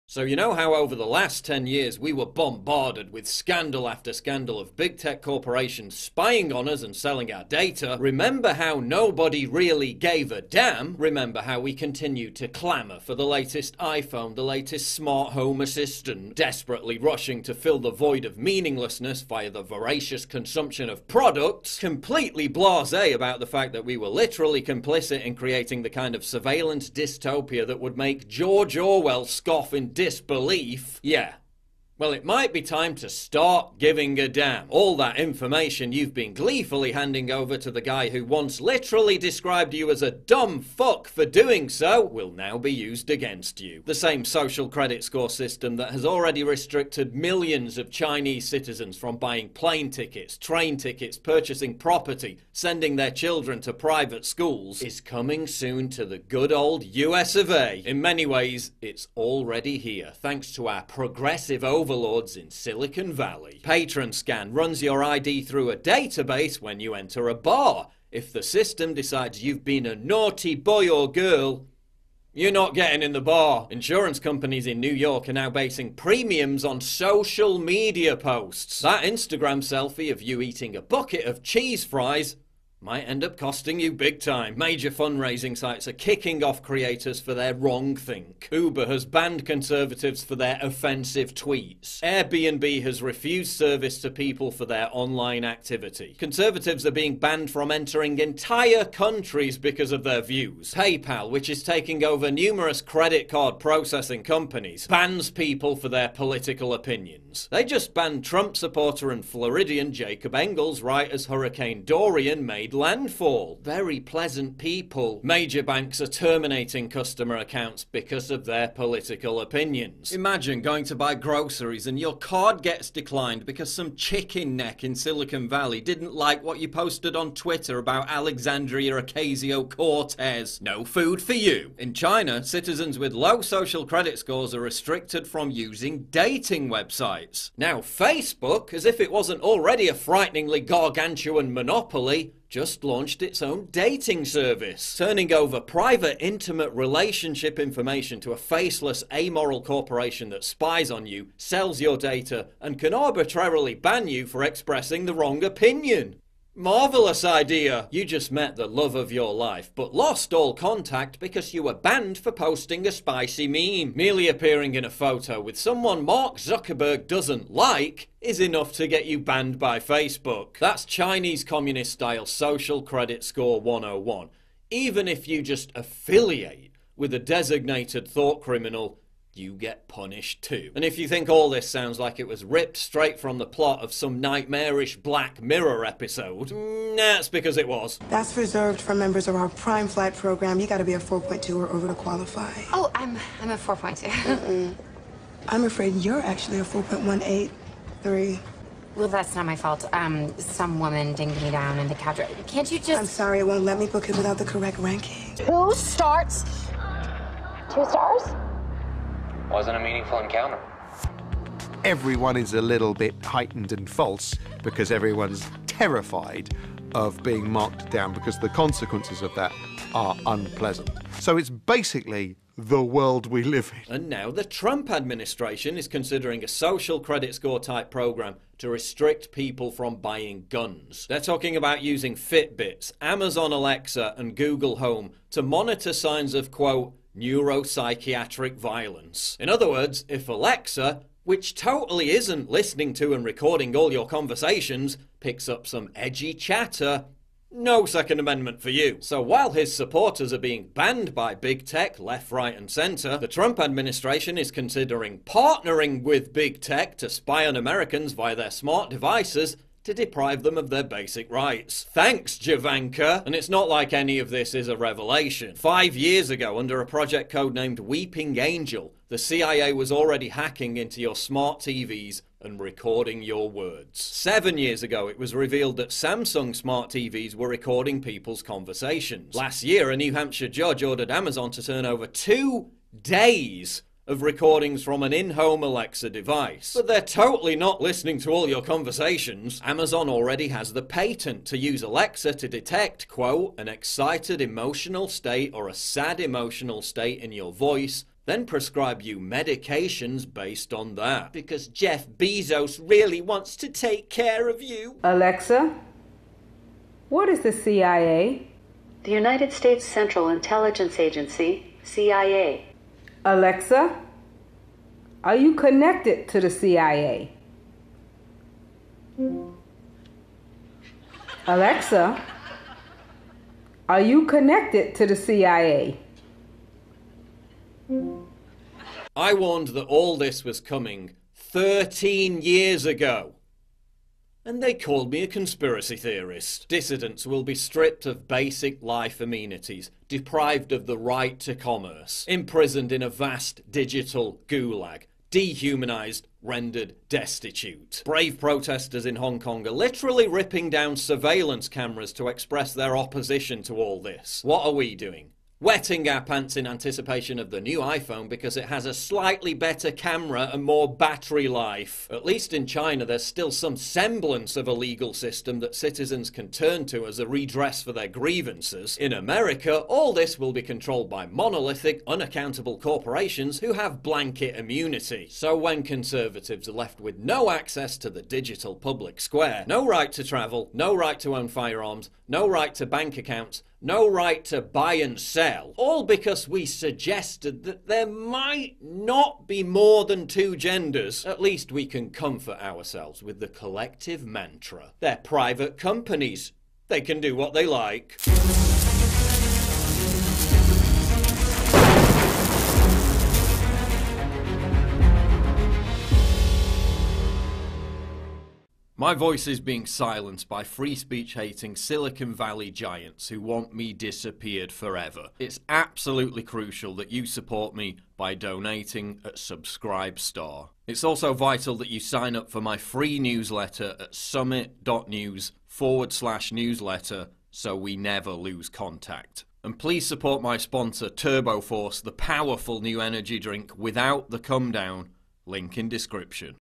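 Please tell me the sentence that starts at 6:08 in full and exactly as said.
In America, all this will be controlled by monolithic, unaccountable corporations who have blanket immunity.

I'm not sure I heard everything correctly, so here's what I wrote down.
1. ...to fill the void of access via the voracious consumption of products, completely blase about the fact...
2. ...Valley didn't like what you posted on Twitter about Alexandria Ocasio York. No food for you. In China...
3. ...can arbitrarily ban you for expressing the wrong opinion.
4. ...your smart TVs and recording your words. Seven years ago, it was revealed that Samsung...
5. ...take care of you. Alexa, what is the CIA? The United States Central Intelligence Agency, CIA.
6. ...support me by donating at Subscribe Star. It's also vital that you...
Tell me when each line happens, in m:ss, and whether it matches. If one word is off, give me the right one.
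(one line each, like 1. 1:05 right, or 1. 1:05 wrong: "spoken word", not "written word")
1. 0:17 wrong: "meaninglessness", not "access"
2. 2:05 wrong: "Cortez", not "York"
3. 2:32 right
4. 4:31 right
5. 5:03 right
6. 6:57 right.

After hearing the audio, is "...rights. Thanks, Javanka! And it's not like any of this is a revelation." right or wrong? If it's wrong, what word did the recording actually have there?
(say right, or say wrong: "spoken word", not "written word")
right.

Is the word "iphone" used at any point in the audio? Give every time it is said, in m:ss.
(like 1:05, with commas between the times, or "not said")
0:13, 5:57.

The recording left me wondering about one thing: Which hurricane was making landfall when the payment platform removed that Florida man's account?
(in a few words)
Hurricane Dorian.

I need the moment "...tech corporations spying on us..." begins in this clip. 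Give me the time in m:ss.
0:04.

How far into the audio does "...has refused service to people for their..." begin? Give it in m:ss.
1:32.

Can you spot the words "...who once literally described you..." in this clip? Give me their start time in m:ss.
0:38.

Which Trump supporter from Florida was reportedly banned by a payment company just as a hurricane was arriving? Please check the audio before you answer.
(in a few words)
Jacob Engels.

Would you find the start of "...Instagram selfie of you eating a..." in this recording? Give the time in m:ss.
1:19.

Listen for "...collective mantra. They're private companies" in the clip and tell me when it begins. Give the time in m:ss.
6:33.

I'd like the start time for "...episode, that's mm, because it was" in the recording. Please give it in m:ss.
3:05.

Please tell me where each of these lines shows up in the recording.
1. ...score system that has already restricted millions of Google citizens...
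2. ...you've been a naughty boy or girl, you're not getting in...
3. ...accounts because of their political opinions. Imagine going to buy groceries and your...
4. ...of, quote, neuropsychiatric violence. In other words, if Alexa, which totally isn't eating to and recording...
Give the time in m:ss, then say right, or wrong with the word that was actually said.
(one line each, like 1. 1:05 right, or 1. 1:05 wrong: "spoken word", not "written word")
1. 0:45 wrong: "Chinese", not "Google"
2. 1:09 right
3. 1:57 right
4. 3:56 wrong: "listening", not "eating".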